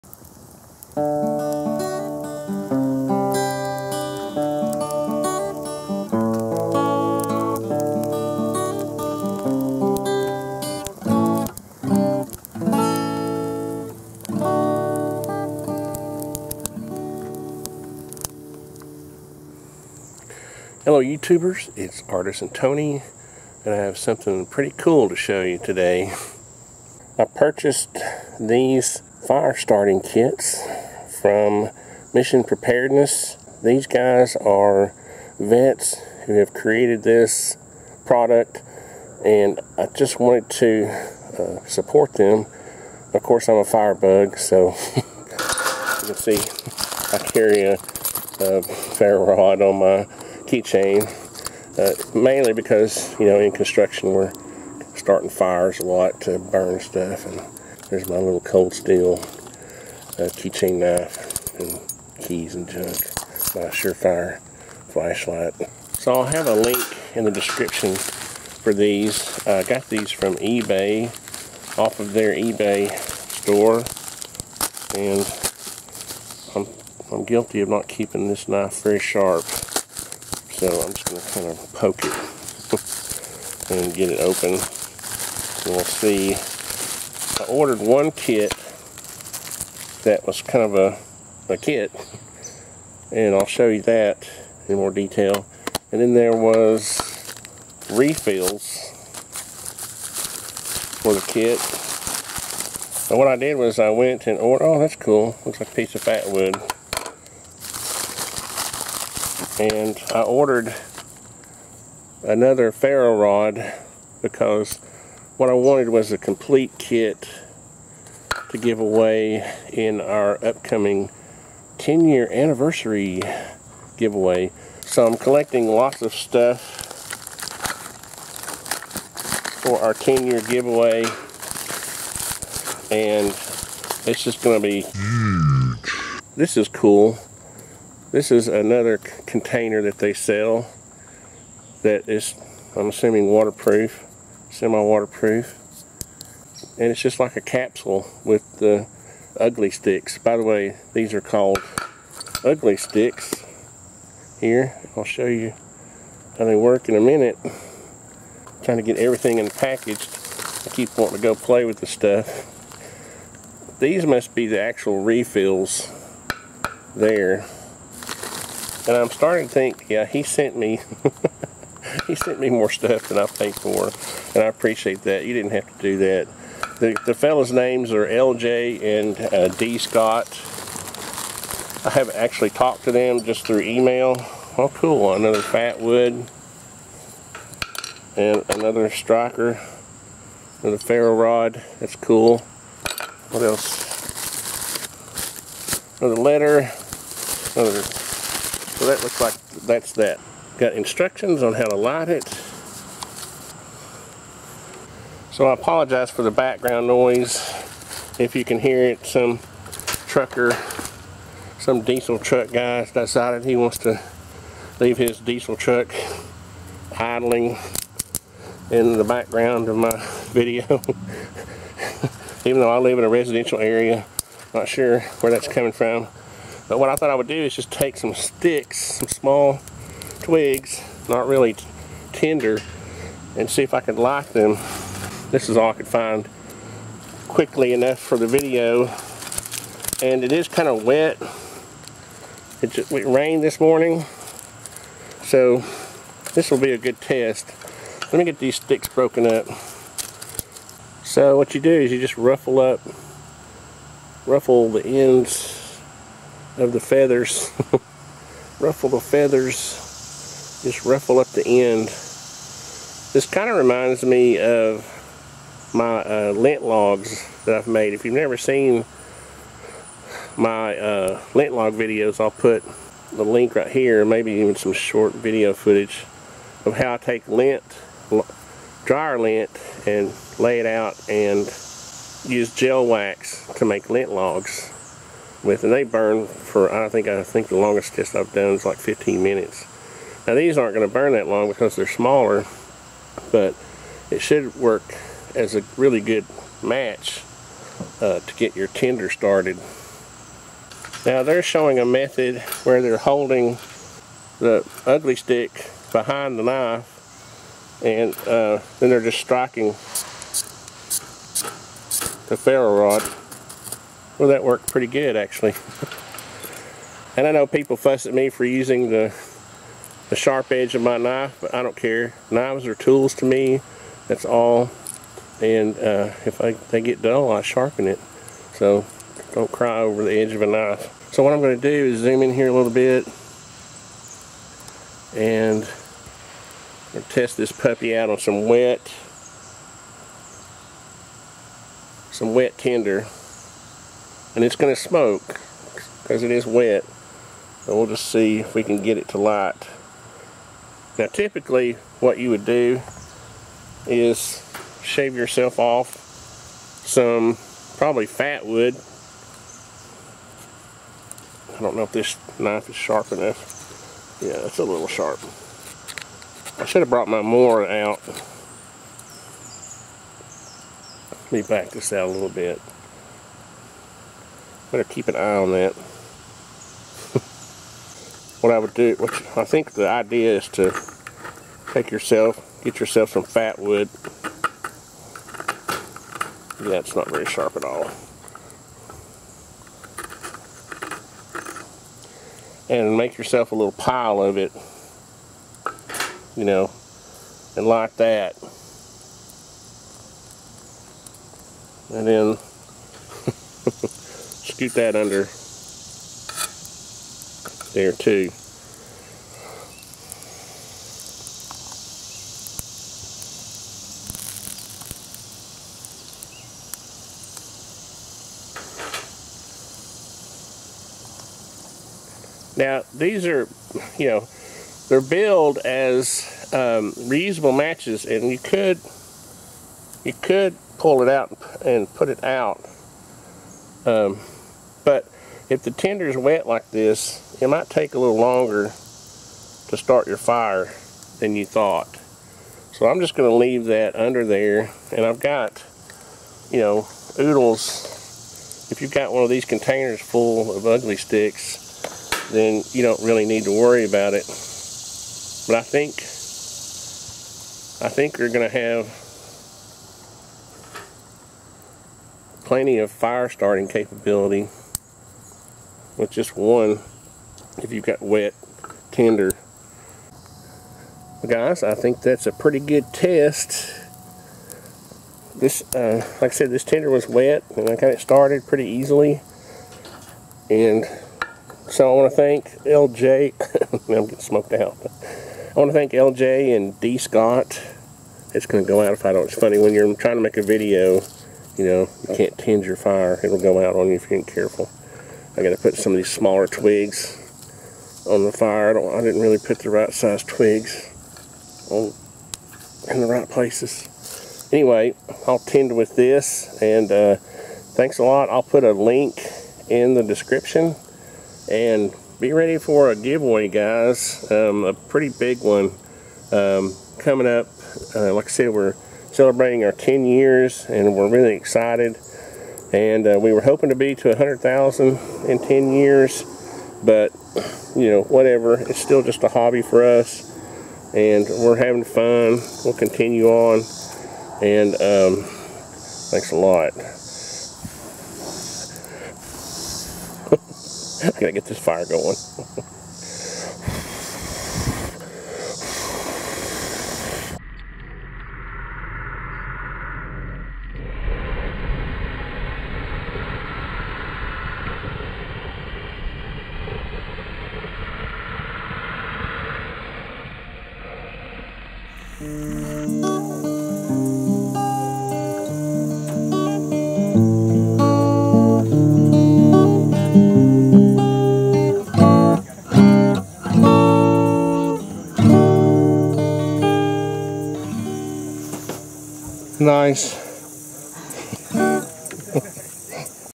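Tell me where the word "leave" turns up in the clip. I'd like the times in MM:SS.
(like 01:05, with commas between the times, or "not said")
03:34, 07:23.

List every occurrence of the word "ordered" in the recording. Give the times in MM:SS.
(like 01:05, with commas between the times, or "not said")
01:27, 01:44, 01:50.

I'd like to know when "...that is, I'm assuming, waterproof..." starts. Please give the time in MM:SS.
02:21.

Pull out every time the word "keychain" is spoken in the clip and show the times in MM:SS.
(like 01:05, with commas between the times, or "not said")
00:50, 01:00.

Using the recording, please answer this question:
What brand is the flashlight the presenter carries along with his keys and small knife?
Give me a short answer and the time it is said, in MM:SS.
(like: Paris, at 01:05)
Surefire, at 01:03.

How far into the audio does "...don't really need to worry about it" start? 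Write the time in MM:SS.
07:32.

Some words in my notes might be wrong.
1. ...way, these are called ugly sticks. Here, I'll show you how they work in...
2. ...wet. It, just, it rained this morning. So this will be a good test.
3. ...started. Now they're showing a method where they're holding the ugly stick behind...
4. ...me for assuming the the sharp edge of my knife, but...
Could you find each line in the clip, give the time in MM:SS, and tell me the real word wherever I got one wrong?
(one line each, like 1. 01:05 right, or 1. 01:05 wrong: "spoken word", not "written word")
1. 02:30 right
2. 04:00 right
3. 04:59 right
4. 05:18 wrong: "using", not "assuming".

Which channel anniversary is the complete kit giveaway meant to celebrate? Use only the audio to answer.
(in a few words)
10 year.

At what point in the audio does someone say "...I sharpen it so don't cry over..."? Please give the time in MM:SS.
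05:27.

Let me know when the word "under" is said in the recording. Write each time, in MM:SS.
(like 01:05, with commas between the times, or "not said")
06:44, 07:23.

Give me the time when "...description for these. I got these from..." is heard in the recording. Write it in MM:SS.
01:07.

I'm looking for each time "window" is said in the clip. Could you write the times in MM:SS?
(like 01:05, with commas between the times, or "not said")
not said.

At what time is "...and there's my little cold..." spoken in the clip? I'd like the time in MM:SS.
00:57.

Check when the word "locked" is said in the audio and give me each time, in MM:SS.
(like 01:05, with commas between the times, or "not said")
not said.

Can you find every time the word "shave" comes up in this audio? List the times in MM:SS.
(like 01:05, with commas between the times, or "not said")
05:54.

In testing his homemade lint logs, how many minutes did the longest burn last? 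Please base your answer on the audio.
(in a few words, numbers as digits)
15 minutes.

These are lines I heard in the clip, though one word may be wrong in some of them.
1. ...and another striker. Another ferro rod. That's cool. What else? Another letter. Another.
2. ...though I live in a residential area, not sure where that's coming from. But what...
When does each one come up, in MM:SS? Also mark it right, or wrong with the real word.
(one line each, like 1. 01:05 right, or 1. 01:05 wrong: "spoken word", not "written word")
1. 03:08 right
2. 03:42 right.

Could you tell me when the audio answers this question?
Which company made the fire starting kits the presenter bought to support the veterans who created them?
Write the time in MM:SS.
00:32.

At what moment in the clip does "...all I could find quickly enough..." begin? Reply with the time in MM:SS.
03:55.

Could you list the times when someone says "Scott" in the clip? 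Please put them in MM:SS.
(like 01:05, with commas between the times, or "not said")
02:59, 08:06.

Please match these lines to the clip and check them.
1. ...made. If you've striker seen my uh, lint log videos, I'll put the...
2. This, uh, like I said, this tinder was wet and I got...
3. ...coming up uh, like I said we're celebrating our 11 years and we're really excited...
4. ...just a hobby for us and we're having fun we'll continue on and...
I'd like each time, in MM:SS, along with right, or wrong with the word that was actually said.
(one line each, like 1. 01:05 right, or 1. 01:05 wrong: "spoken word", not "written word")
1. 04:27 wrong: "never", not "striker"
2. 07:55 right
3. 08:36 wrong: "10", not "11"
4. 08:49 right.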